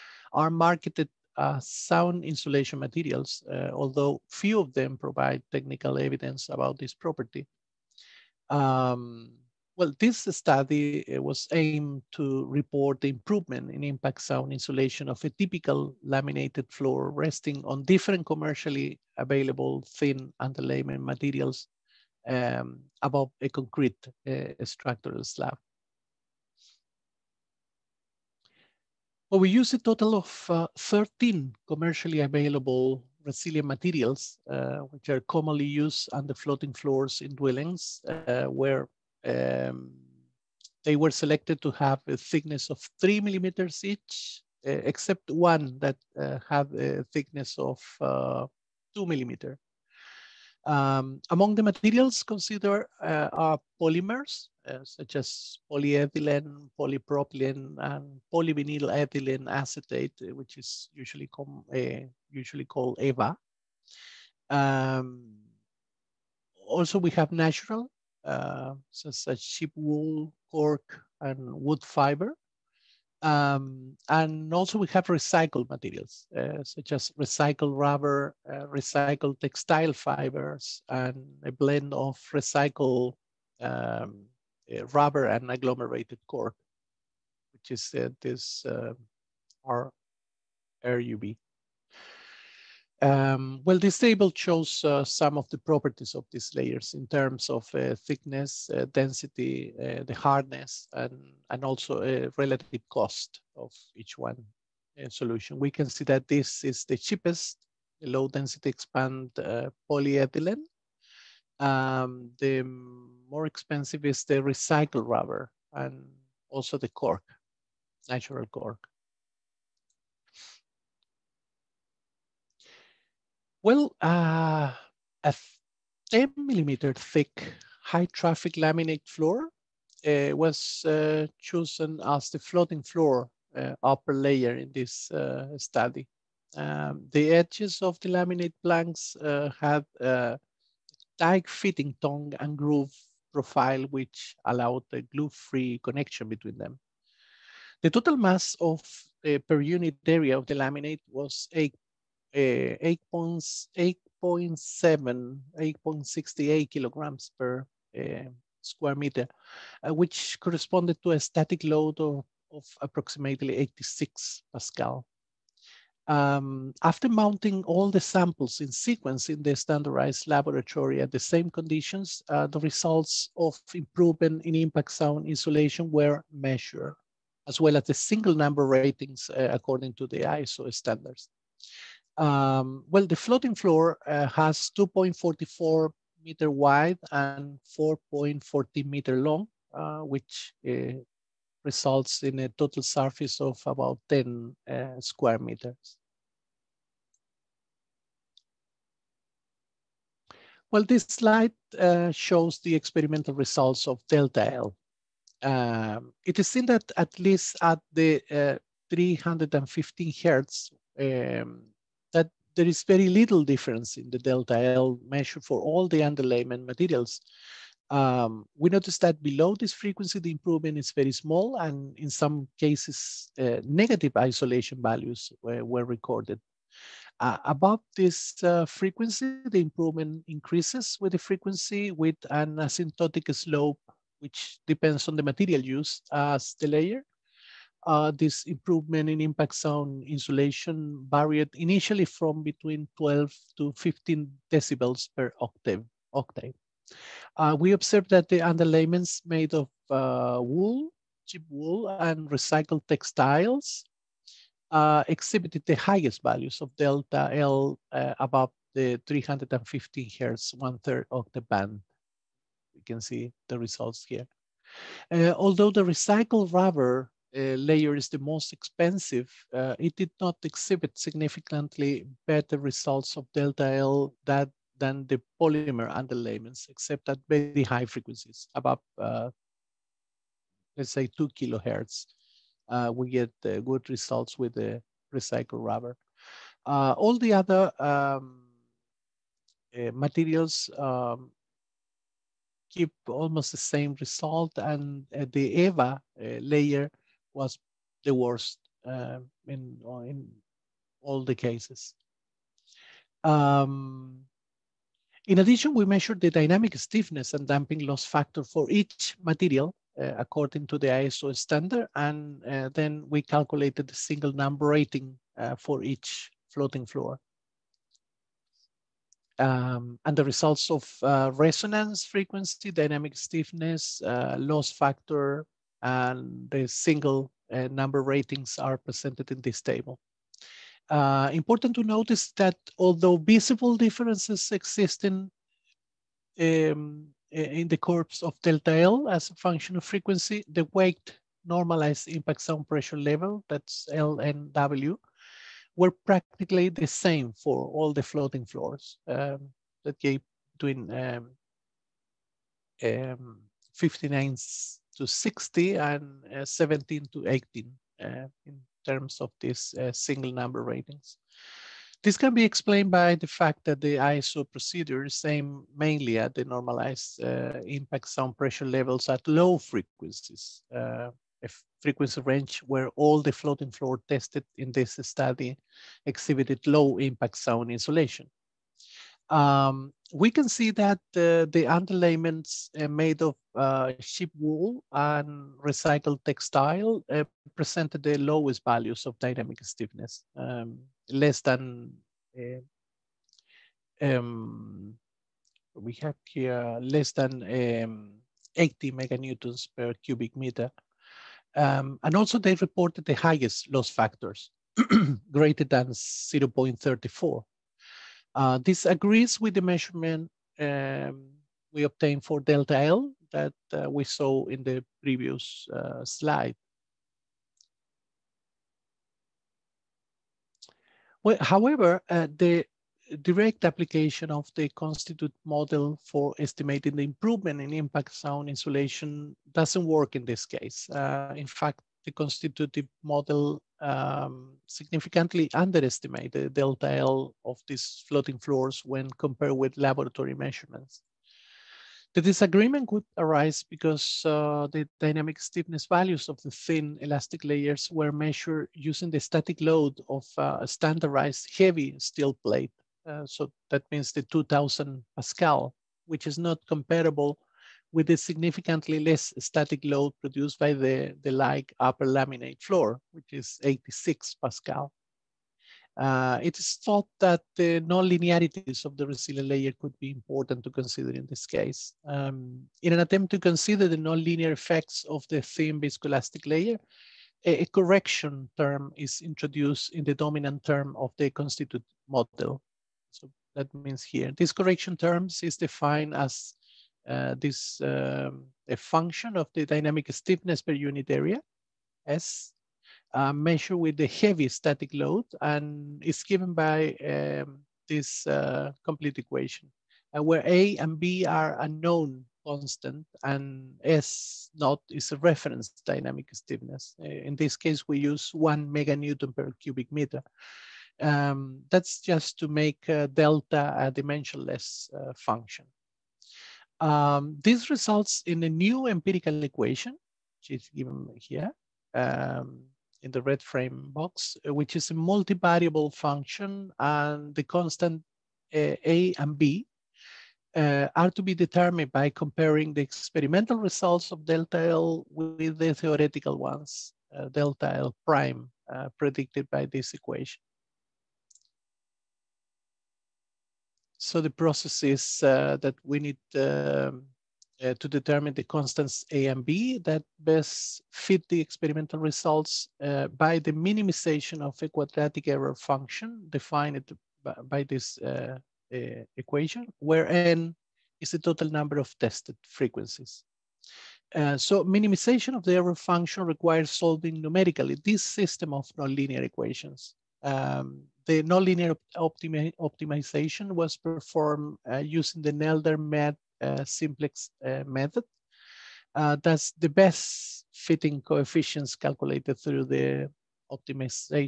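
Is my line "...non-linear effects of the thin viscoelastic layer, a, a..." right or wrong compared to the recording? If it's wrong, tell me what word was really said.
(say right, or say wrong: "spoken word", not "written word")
right.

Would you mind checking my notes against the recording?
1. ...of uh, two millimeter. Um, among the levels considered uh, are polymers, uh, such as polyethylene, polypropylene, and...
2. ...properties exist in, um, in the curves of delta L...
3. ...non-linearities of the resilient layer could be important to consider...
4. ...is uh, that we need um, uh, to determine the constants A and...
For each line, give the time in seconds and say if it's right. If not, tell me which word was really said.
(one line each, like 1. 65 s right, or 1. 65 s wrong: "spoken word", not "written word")
1. 47 s wrong: "materials", not "levels"
2. 333 s wrong: "differences", not "properties"
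3. 467 s right
4. 544 s right.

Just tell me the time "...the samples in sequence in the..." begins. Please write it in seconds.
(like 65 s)
167 s.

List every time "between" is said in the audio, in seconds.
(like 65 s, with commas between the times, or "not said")
146 s, 242 s, 350 s.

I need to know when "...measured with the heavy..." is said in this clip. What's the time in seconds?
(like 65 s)
493 s.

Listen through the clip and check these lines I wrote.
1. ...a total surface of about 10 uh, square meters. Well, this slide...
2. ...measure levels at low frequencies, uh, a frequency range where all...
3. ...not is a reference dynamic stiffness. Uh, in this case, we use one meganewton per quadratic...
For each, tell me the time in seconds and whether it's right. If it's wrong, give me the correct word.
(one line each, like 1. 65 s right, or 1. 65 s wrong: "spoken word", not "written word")
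1. 192 s right
2. 368 s wrong: "pressure", not "measure"
3. 504 s wrong: "cubic", not "quadratic".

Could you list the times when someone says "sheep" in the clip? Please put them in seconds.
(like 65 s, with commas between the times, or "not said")
69 s, 251 s, 383 s.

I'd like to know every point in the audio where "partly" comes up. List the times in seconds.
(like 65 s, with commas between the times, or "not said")
not said.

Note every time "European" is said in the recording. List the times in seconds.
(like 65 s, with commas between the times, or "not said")
not said.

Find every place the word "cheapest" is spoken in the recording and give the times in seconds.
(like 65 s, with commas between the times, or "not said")
106 s.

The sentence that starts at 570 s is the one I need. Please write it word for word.
Um, the nonlinear optimi optimization was performed uh, using the Nelder-Mead uh, simplex uh, method.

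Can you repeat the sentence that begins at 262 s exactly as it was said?
You can see the results here.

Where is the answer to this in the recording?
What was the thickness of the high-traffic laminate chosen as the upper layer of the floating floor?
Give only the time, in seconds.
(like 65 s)
126 s.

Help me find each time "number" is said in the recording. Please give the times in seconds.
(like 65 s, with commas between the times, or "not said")
178 s, 314 s, 327 s, 360 s, 561 s.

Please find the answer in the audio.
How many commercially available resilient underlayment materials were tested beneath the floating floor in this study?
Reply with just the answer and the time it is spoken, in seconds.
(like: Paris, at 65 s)
13, at 30 s.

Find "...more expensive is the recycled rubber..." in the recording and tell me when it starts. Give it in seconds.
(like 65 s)
112 s.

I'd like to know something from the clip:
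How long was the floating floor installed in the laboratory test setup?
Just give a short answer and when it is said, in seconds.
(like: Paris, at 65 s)
4.40 meters, at 187 s.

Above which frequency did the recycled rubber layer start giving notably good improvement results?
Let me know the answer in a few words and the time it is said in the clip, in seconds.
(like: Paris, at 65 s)
2 kilohertz, at 281 s.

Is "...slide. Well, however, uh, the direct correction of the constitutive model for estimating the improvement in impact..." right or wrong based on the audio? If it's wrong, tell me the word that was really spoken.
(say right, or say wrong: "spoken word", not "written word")
wrong: "application", not "correction".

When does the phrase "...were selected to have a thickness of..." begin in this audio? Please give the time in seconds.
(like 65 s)
40 s.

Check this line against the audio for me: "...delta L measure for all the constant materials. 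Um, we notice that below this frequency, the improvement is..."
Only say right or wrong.
wrong.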